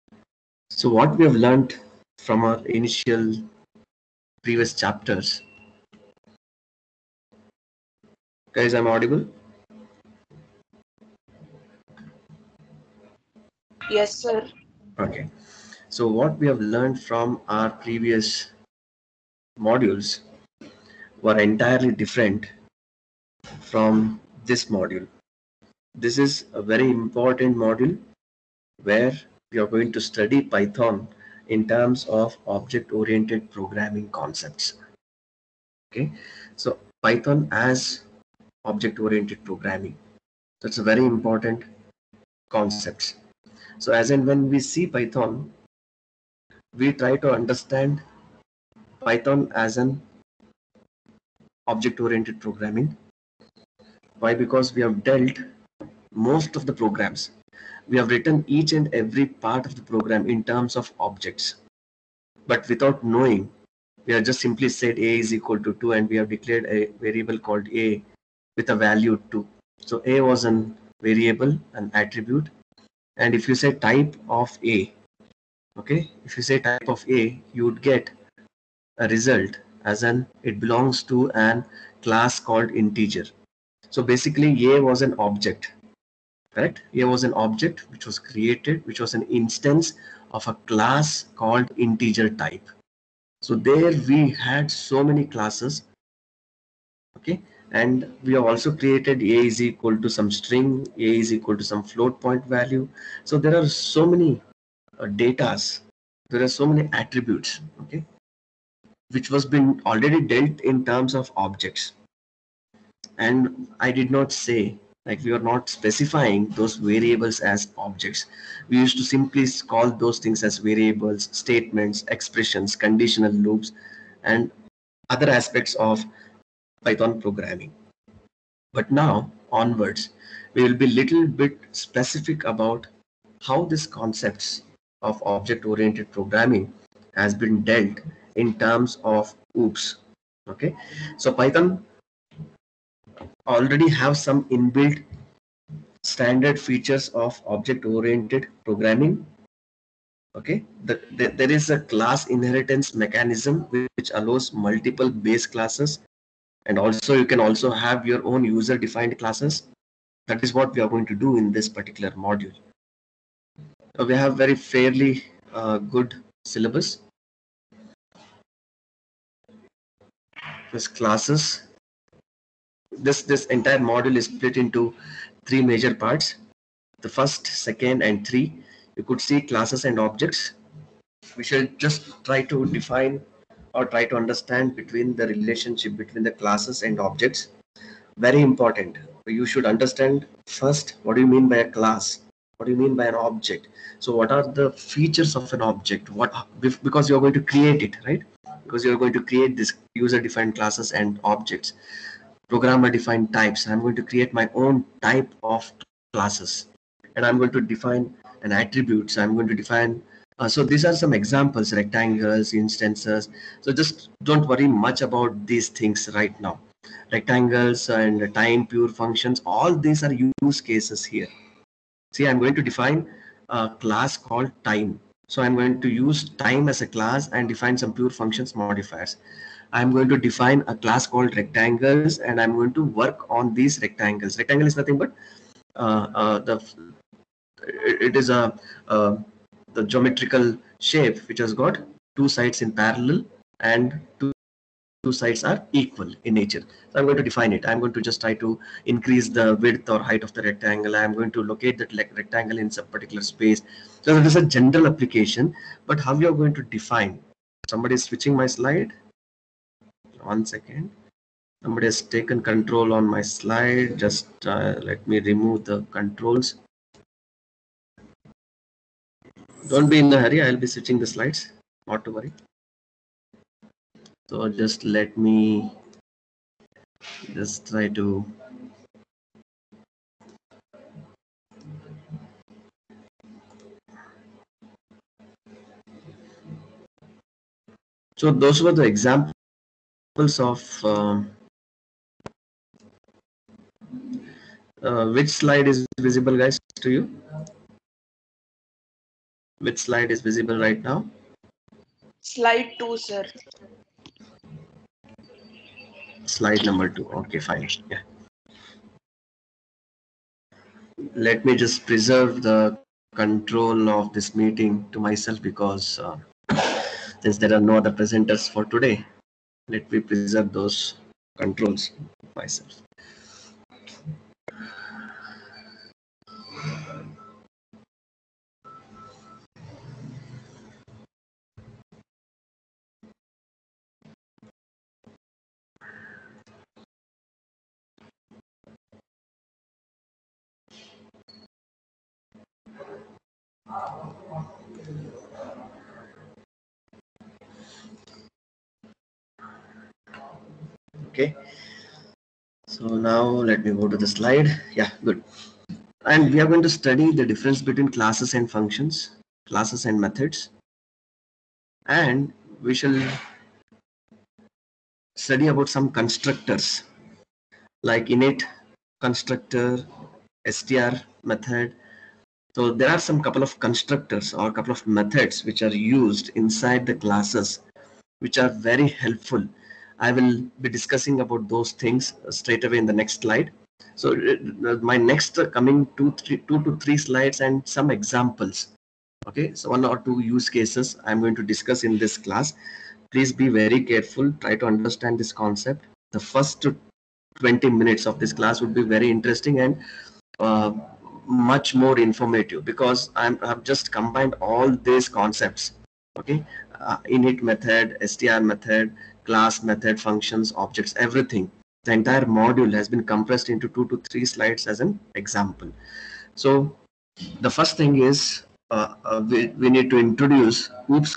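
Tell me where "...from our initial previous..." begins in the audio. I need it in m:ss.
0:02.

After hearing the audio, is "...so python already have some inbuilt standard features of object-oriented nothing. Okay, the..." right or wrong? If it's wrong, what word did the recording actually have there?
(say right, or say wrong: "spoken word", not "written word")
wrong: "programming", not "nothing".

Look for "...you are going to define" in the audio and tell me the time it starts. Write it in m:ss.
4:16.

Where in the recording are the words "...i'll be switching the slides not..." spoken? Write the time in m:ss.
4:30.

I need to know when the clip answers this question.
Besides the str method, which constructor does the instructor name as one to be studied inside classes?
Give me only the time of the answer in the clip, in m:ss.
6:08.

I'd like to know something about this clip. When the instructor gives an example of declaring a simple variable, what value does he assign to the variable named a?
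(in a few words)
2.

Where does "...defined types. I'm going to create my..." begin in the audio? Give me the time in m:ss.
3:22.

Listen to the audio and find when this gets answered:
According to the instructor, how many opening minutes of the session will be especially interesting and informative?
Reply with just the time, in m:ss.
6:37.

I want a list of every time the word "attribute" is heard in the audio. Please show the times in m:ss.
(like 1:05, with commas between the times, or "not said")
1:11, 1:47, 3:28.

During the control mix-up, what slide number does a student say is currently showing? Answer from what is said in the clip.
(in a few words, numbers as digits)
2.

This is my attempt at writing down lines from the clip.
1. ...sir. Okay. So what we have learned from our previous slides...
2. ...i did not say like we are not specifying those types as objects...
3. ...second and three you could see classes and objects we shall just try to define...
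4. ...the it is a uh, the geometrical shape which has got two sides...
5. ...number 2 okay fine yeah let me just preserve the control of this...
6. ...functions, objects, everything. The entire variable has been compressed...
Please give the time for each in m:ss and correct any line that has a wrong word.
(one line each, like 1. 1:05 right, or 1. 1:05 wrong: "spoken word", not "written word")
1. 0:14 wrong: "modules", not "slides"
2. 1:53 wrong: "variables", not "types"
3. 2:57 right
4. 3:56 right
5. 5:06 right
6. 6:50 wrong: "module", not "variable".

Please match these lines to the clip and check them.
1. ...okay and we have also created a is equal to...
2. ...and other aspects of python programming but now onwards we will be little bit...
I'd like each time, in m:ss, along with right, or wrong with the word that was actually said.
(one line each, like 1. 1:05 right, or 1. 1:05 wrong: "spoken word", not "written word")
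1. 1:37 right
2. 2:04 right.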